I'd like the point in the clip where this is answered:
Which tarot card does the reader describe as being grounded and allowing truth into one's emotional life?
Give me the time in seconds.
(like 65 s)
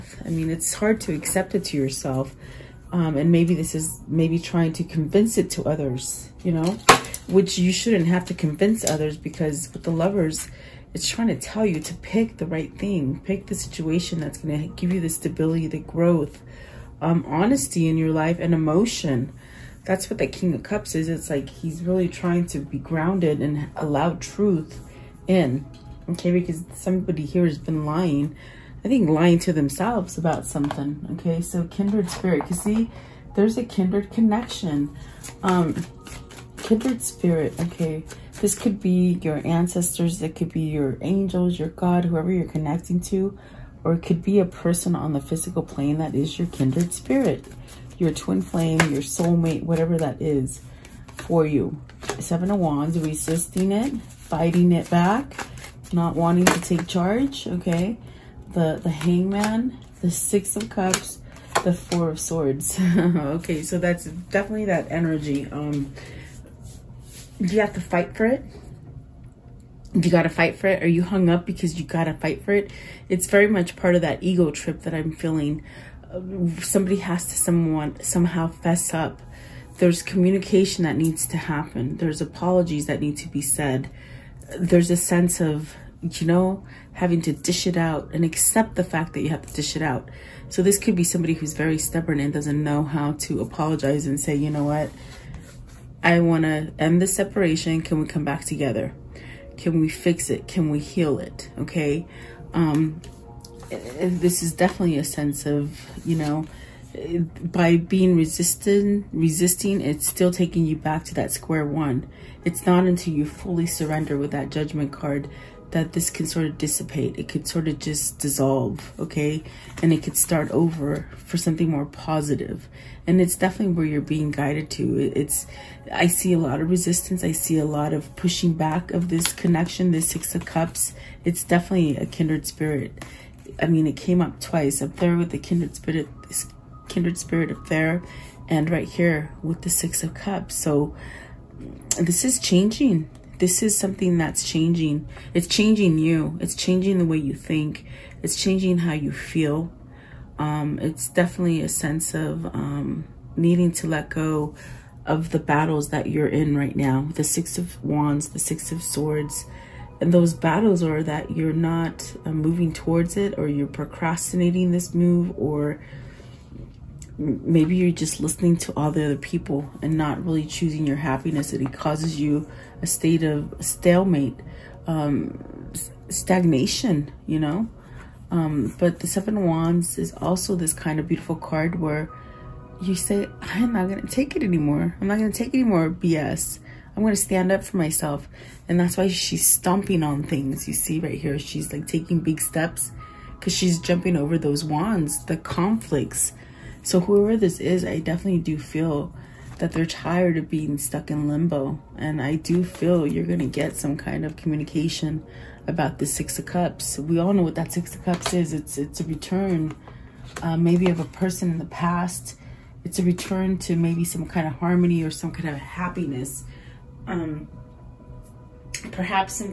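20 s.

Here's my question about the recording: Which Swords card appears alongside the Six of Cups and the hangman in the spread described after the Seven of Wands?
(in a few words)
Four of Swords.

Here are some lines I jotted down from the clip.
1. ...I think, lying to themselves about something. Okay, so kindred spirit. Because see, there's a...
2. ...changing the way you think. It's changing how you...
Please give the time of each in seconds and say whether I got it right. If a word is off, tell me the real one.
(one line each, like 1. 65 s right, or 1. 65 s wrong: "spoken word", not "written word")
1. 28 s right
2. 146 s right.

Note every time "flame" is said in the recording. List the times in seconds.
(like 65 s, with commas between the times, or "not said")
48 s.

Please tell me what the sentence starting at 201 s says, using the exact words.
And I do feel you're going to get some kind of communication about the Six of Cups.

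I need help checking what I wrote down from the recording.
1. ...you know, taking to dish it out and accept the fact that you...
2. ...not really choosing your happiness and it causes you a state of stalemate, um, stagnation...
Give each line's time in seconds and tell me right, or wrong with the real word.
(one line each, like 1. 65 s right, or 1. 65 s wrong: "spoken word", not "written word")
1. 86 s wrong: "having", not "taking"
2. 169 s right.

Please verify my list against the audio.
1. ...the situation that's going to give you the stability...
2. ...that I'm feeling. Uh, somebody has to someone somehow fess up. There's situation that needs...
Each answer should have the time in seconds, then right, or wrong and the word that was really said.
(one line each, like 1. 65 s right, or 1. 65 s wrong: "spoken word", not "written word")
1. 13 s right
2. 74 s wrong: "communication", not "situation".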